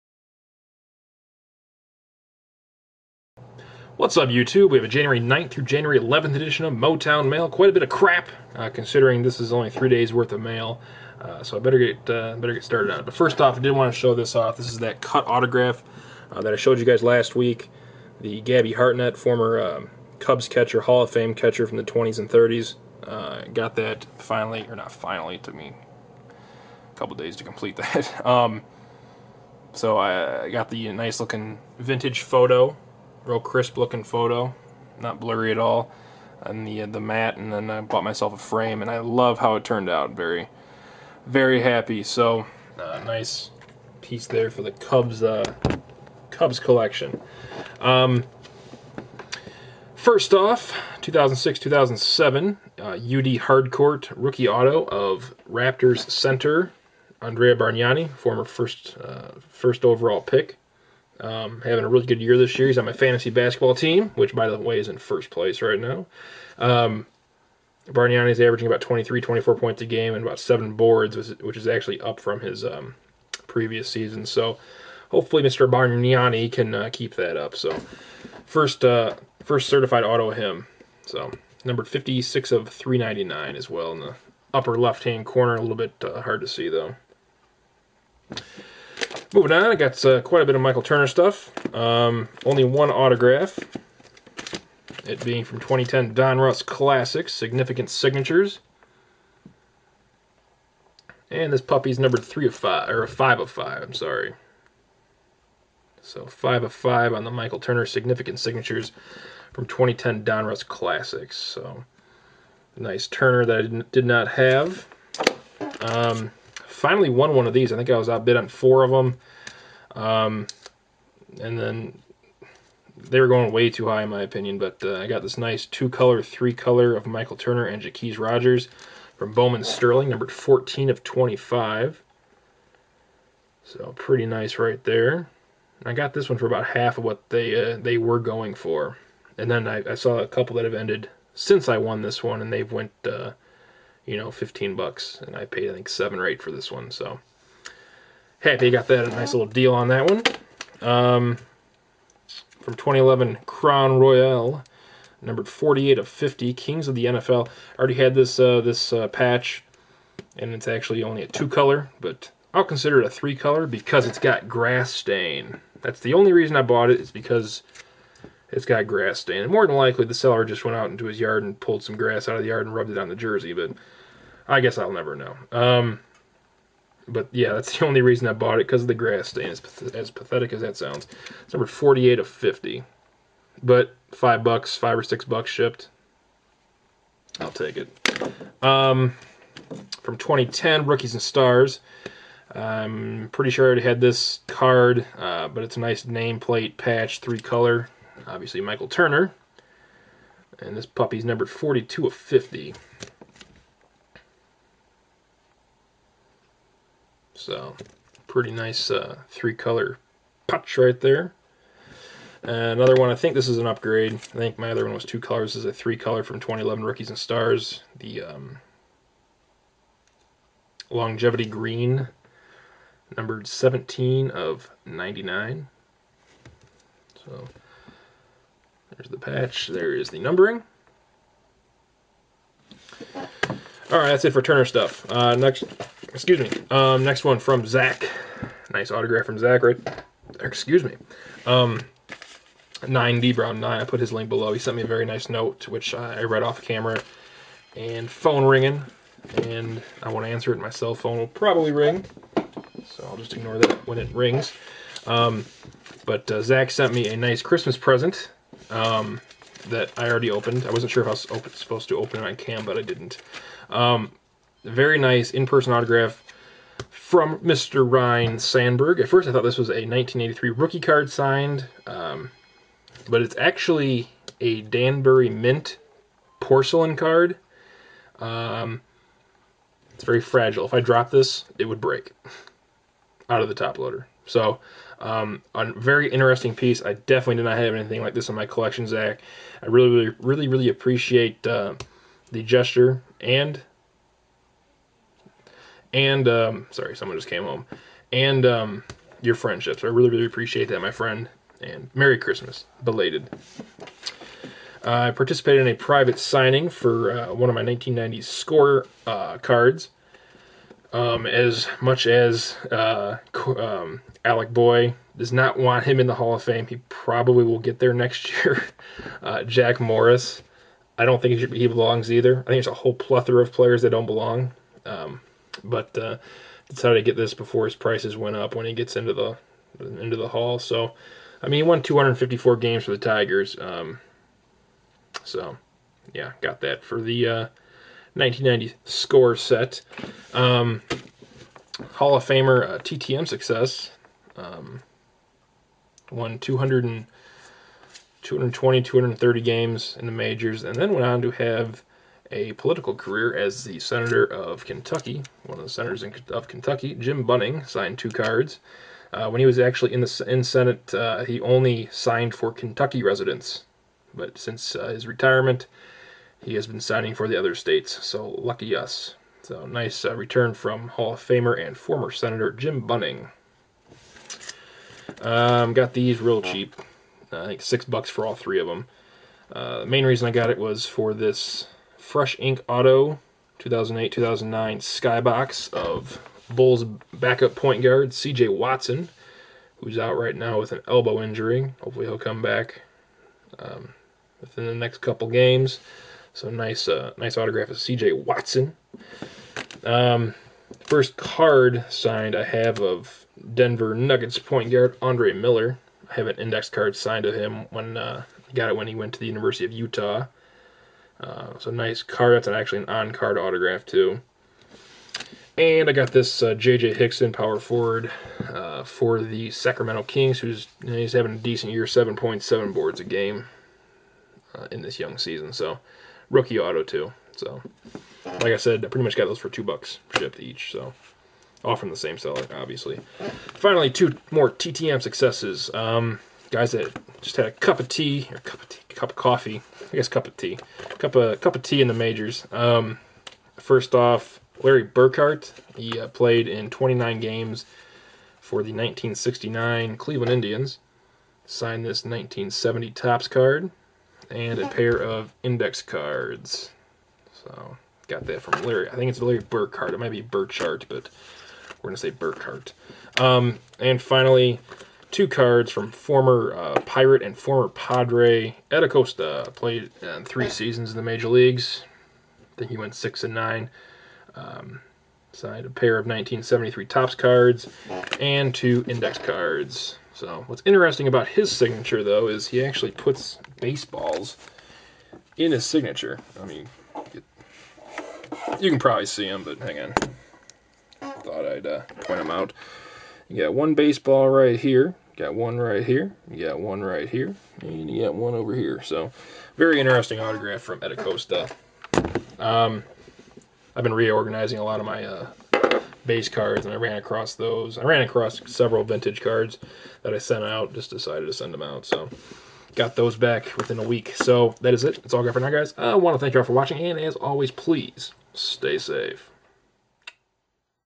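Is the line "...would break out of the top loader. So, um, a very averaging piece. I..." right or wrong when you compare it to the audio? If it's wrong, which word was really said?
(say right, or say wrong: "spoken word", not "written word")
wrong: "interesting", not "averaging".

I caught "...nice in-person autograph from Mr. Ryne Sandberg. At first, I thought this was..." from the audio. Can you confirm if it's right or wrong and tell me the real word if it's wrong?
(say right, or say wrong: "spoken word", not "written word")
right.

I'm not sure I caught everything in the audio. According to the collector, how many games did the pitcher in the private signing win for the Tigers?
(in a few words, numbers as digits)
254.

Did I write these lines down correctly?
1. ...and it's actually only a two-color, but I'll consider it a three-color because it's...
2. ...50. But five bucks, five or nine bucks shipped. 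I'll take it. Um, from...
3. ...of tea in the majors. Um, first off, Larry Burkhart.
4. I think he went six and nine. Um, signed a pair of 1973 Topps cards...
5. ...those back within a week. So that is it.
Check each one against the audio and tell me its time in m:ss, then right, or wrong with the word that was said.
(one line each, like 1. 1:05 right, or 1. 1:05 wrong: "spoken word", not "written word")
1. 2:40 right
2. 3:02 wrong: "six", not "nine"
3. 7:21 right
4. 7:52 right
5. 8:32 right.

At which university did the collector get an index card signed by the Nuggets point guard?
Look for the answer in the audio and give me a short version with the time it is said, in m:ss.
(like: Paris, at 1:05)
University of Utah, at 6:49.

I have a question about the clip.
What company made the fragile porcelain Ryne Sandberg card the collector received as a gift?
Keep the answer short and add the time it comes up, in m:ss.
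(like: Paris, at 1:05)
Danbury Mint, at 4:34.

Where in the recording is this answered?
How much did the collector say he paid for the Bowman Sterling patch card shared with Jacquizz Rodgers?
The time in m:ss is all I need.
2:25.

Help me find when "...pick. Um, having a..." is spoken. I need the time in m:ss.
1:00.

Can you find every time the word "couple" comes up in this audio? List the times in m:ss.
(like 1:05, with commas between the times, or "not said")
0:26, 2:20, 6:34.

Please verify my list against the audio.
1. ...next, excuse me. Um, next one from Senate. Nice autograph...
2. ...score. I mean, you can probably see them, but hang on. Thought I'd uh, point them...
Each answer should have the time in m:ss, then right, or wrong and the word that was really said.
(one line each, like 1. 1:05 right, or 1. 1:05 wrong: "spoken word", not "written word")
1. 3:55 wrong: "Zach", not "Senate"
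2. 8:05 wrong: "signature", not "score".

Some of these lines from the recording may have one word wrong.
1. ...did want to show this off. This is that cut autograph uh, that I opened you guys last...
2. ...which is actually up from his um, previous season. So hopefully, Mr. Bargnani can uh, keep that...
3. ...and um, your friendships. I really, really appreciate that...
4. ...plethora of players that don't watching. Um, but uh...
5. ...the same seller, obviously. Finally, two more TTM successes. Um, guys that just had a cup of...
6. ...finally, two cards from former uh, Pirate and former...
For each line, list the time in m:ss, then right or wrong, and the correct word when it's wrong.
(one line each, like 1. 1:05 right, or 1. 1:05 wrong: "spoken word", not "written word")
1. 0:13 wrong: "showed", not "opened"
2. 1:11 right
3. 4:58 right
4. 5:22 wrong: "belong", not "watching"
5. 7:11 right
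6. 7:44 right.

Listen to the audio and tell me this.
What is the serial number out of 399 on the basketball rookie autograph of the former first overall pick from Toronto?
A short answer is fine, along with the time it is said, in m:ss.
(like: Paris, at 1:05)
56, at 1:21.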